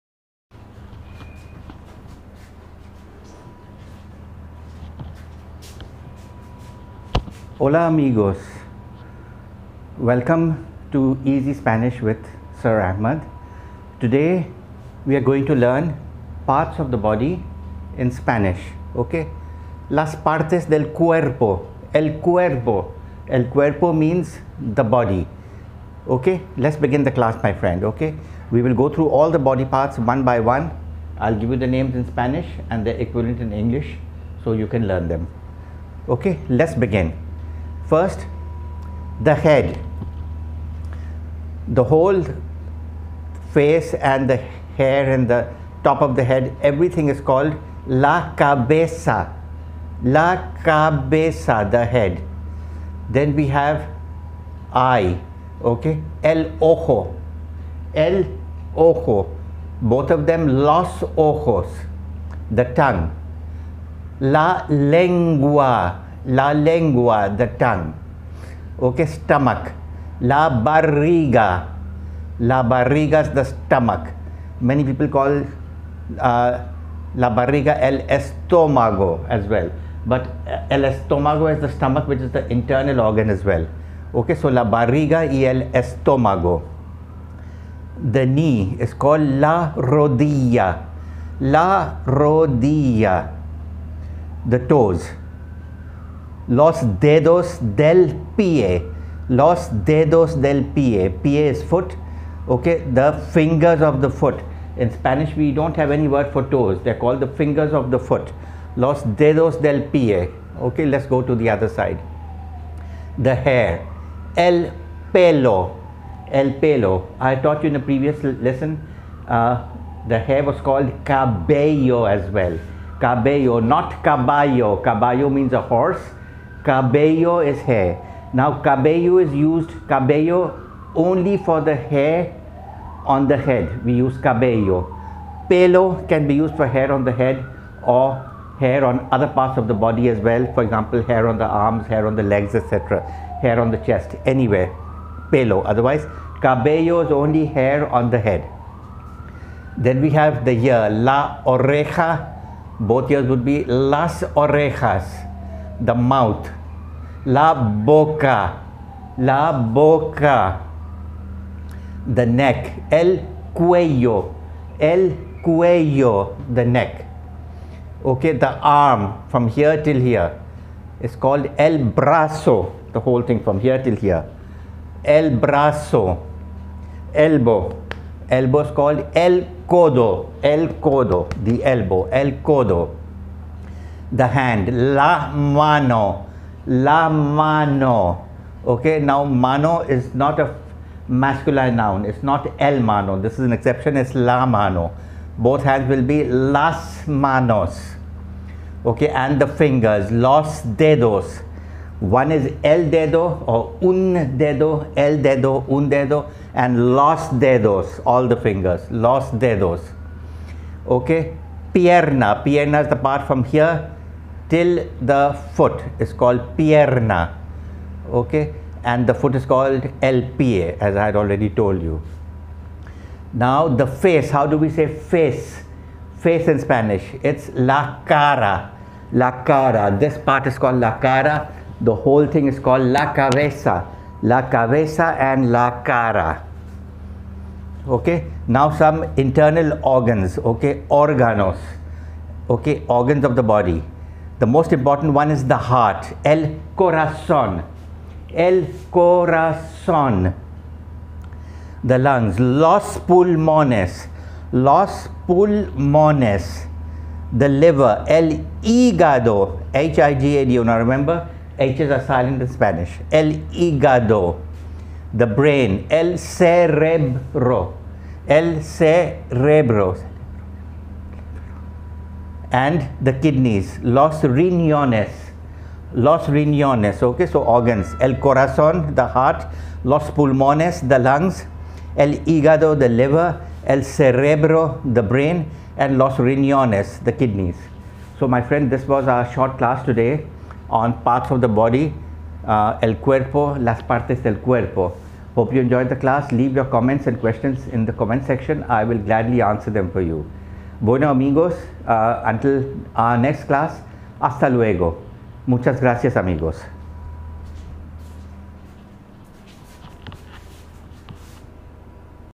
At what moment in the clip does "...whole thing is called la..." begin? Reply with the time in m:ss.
3:51.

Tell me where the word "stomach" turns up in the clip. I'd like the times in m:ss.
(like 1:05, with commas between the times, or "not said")
1:09, 1:13, 1:21.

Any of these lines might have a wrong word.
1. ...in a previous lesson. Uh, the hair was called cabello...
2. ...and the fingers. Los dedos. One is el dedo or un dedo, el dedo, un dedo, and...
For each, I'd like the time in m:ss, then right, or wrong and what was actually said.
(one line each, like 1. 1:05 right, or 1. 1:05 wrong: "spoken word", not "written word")
1. 1:57 right
2. 3:19 right.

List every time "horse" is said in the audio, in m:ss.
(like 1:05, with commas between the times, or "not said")
2:05.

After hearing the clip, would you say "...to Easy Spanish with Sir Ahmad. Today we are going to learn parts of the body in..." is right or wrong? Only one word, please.
right.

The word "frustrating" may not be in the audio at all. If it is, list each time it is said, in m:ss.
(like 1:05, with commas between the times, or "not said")
not said.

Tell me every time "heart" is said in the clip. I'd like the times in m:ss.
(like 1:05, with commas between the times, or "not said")
4:05, 4:39.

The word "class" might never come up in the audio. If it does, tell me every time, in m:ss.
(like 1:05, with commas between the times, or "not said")
0:27, 4:49, 4:55, 5:03.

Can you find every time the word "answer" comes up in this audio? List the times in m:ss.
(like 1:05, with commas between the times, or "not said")
4:59.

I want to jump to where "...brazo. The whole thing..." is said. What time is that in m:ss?
2:51.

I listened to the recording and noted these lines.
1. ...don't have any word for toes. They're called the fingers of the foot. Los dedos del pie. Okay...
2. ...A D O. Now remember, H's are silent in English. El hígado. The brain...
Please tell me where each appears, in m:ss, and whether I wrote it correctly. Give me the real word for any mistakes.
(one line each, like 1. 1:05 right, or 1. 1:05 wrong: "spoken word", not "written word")
1. 1:45 right
2. 4:20 wrong: "Spanish", not "English".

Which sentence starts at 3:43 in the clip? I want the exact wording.
Now the face, how do we say face?